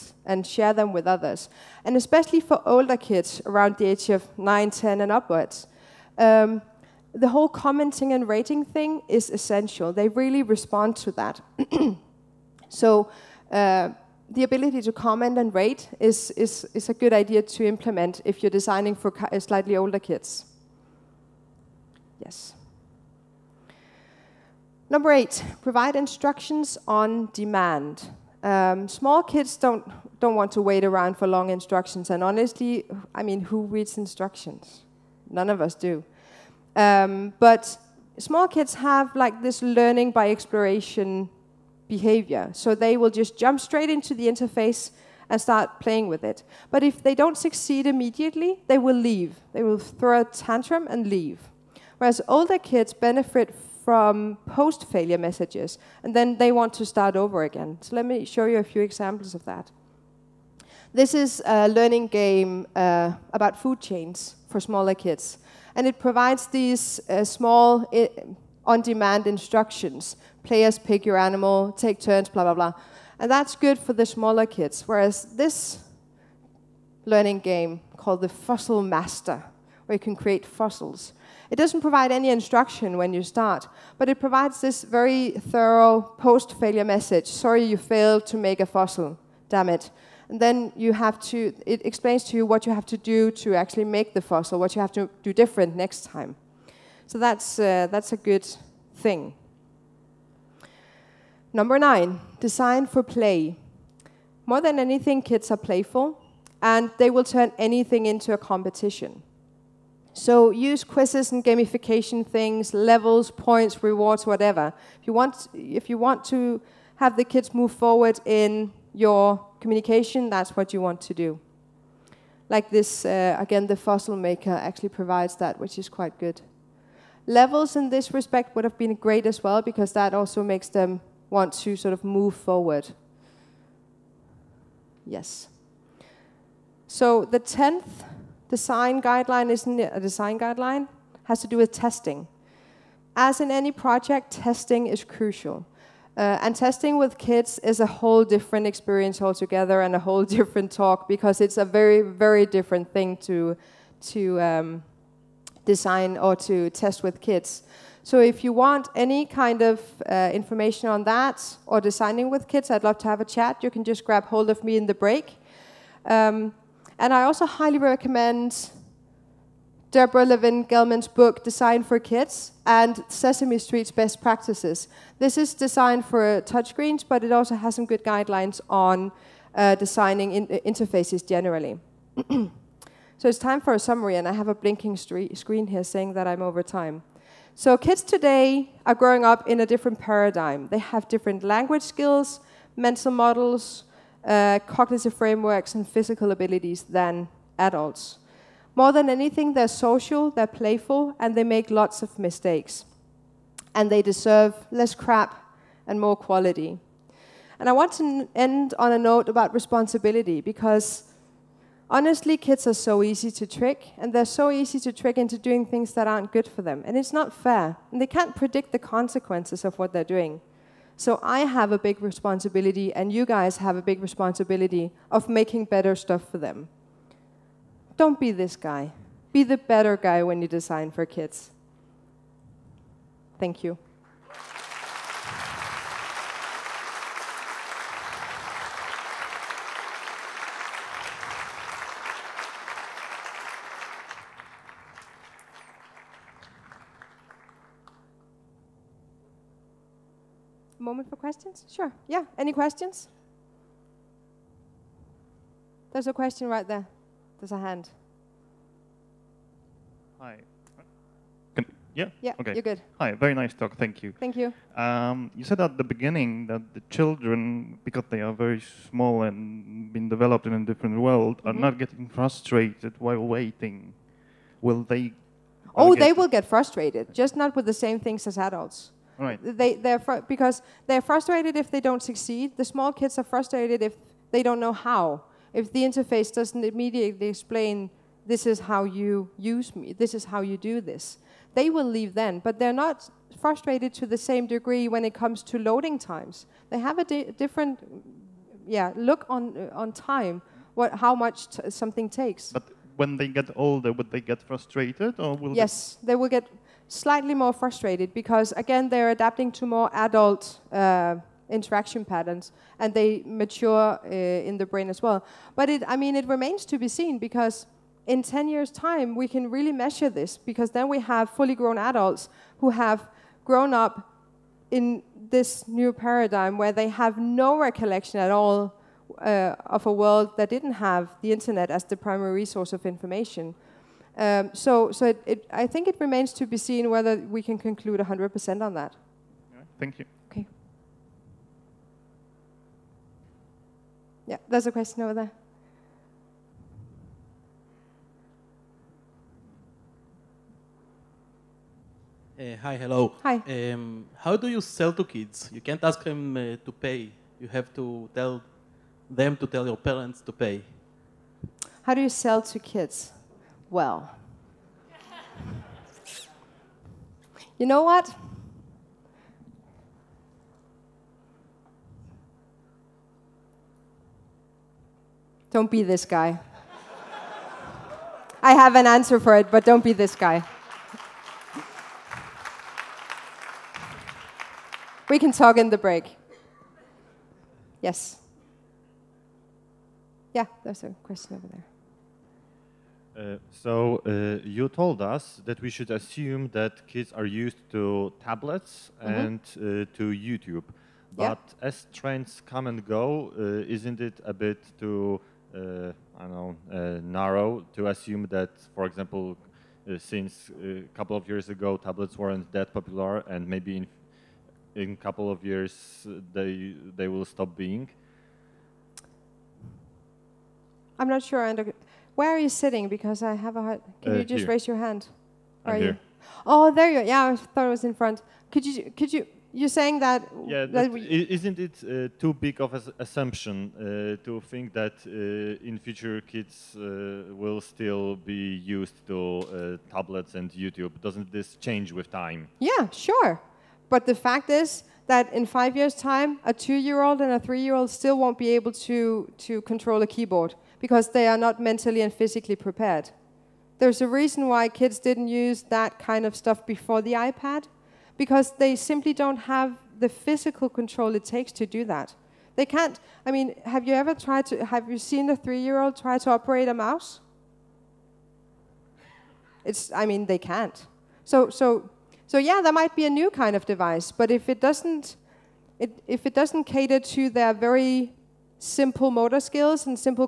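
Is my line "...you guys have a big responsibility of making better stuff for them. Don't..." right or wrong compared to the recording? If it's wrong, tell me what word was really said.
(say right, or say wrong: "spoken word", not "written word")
right.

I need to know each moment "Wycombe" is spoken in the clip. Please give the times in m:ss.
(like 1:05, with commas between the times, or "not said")
not said.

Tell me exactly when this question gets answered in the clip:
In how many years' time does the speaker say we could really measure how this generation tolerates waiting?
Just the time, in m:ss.
5:18.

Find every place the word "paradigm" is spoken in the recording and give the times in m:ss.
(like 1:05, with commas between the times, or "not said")
3:09, 5:25.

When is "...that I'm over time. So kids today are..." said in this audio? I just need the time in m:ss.
3:06.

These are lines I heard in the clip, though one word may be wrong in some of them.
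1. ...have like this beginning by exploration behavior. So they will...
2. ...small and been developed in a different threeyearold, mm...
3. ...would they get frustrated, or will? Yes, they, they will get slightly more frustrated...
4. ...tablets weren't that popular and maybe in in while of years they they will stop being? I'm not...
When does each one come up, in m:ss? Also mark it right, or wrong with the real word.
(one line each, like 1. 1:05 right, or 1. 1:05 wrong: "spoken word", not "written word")
1. 0:38 wrong: "learning", not "beginning"
2. 4:28 wrong: "world", not "threeyearold"
3. 5:03 right
4. 6:51 wrong: "couple", not "while".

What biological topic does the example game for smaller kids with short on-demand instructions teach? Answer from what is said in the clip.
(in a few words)
Food chains.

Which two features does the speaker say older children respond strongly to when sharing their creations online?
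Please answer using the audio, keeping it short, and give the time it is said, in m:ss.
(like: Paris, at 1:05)
Commenting and rating, at 0:07.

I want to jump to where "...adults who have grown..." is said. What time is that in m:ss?
5:21.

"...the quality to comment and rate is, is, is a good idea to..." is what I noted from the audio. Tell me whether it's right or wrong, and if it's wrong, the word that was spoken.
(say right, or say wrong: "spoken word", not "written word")
wrong: "ability", not "quality".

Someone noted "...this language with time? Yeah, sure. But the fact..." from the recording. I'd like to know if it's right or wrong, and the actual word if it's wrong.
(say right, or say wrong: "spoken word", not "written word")
wrong: "change", not "language".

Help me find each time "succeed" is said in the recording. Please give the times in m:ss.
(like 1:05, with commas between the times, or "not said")
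0:47, 4:42.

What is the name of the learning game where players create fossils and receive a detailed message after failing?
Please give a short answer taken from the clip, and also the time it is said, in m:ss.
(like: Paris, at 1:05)
Fossil Master, at 1:18.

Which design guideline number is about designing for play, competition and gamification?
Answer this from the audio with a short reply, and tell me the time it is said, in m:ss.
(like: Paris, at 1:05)
9, at 1:41.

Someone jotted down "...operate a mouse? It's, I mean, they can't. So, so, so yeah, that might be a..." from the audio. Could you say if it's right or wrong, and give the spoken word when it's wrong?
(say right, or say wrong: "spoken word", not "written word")
right.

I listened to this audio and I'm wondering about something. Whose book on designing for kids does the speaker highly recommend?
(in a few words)
Deborah Levin Gelman.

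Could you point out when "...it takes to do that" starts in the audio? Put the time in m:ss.
7:41.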